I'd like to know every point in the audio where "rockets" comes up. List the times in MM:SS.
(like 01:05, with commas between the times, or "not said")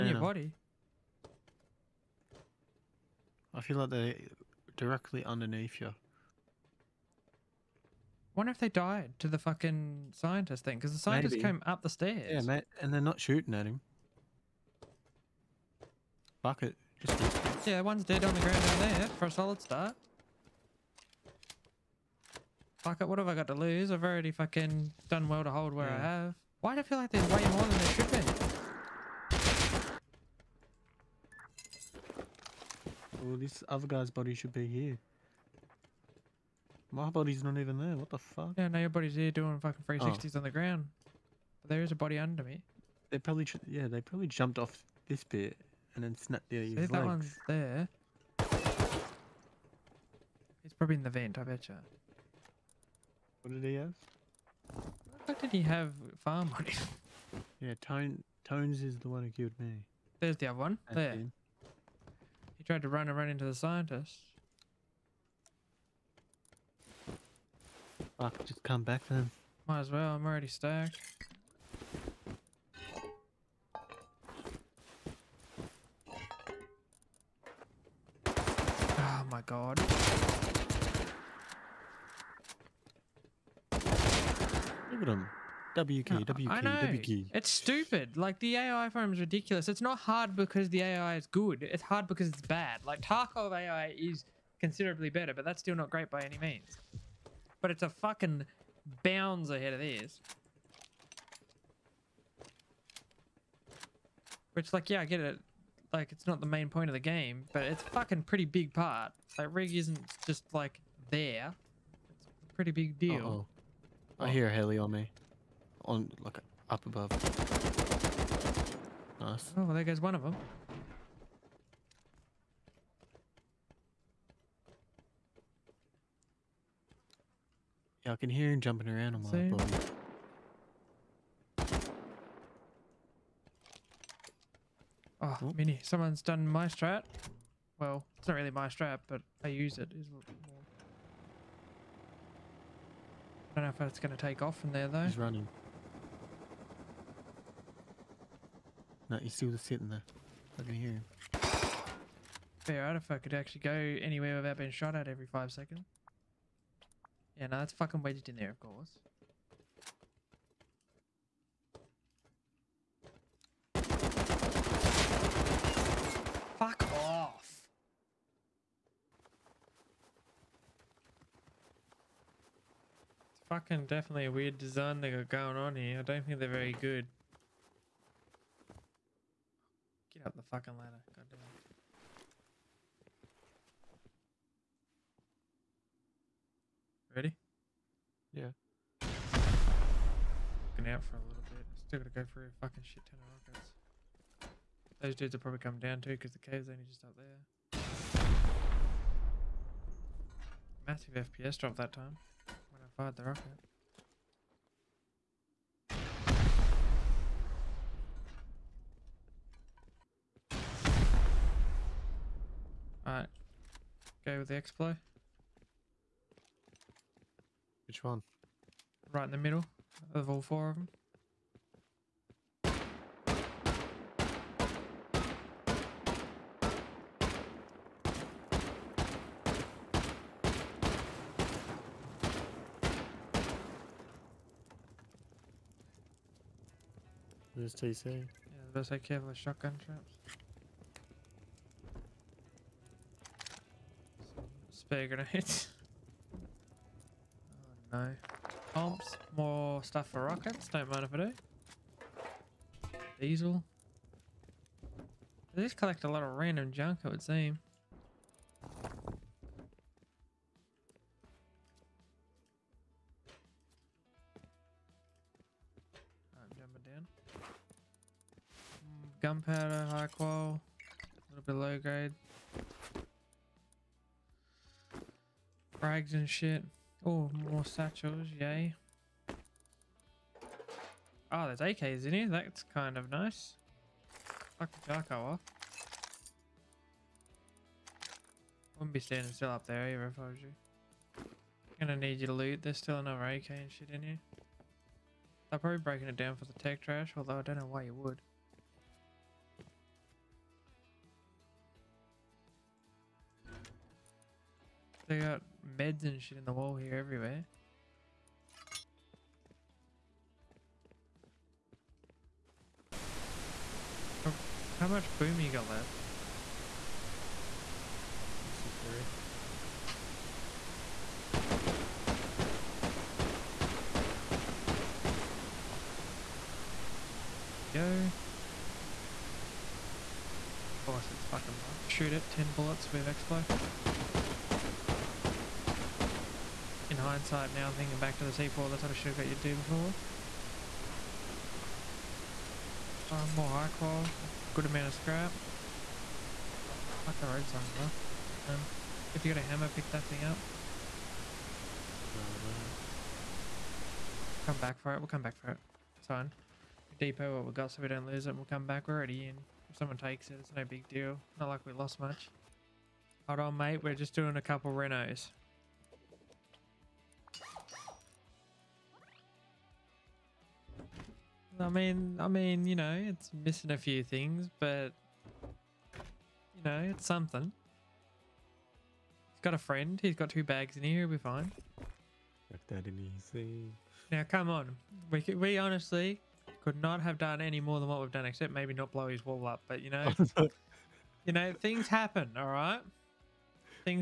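03:13, 03:23, 04:10.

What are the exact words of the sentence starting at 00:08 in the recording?
Wonder if they died to the fucking scientist thing because the scientists came up the stairs.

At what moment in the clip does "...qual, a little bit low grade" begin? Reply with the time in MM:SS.
04:30.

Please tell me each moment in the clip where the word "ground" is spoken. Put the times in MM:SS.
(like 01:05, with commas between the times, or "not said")
00:18, 00:40.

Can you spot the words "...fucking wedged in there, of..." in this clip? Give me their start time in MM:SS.
02:37.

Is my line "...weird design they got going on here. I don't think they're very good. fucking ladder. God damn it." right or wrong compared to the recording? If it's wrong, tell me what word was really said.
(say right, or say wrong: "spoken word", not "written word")
right.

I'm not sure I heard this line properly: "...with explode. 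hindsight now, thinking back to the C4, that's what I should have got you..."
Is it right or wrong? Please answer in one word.
right.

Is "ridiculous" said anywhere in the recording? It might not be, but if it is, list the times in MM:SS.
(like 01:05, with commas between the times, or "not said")
01:29.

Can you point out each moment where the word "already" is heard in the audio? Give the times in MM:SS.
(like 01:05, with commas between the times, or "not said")
00:24, 01:10, 05:58.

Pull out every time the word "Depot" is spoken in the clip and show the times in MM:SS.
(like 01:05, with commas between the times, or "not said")
05:56.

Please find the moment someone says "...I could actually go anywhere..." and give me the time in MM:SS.
02:33.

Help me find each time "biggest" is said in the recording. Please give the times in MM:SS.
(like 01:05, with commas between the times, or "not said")
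not said.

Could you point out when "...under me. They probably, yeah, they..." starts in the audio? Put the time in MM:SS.
00:42.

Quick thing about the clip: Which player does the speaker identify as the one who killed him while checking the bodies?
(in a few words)
Tones.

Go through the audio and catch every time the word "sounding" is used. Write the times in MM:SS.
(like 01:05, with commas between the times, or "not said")
not said.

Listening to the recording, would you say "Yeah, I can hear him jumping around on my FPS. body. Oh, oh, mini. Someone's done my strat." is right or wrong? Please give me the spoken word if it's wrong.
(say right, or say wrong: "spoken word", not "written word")
wrong: "Same", not "FPS".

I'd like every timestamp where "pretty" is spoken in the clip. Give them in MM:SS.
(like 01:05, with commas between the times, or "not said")
01:48, 01:52.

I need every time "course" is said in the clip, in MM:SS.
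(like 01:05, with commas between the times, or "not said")
02:38, 05:30.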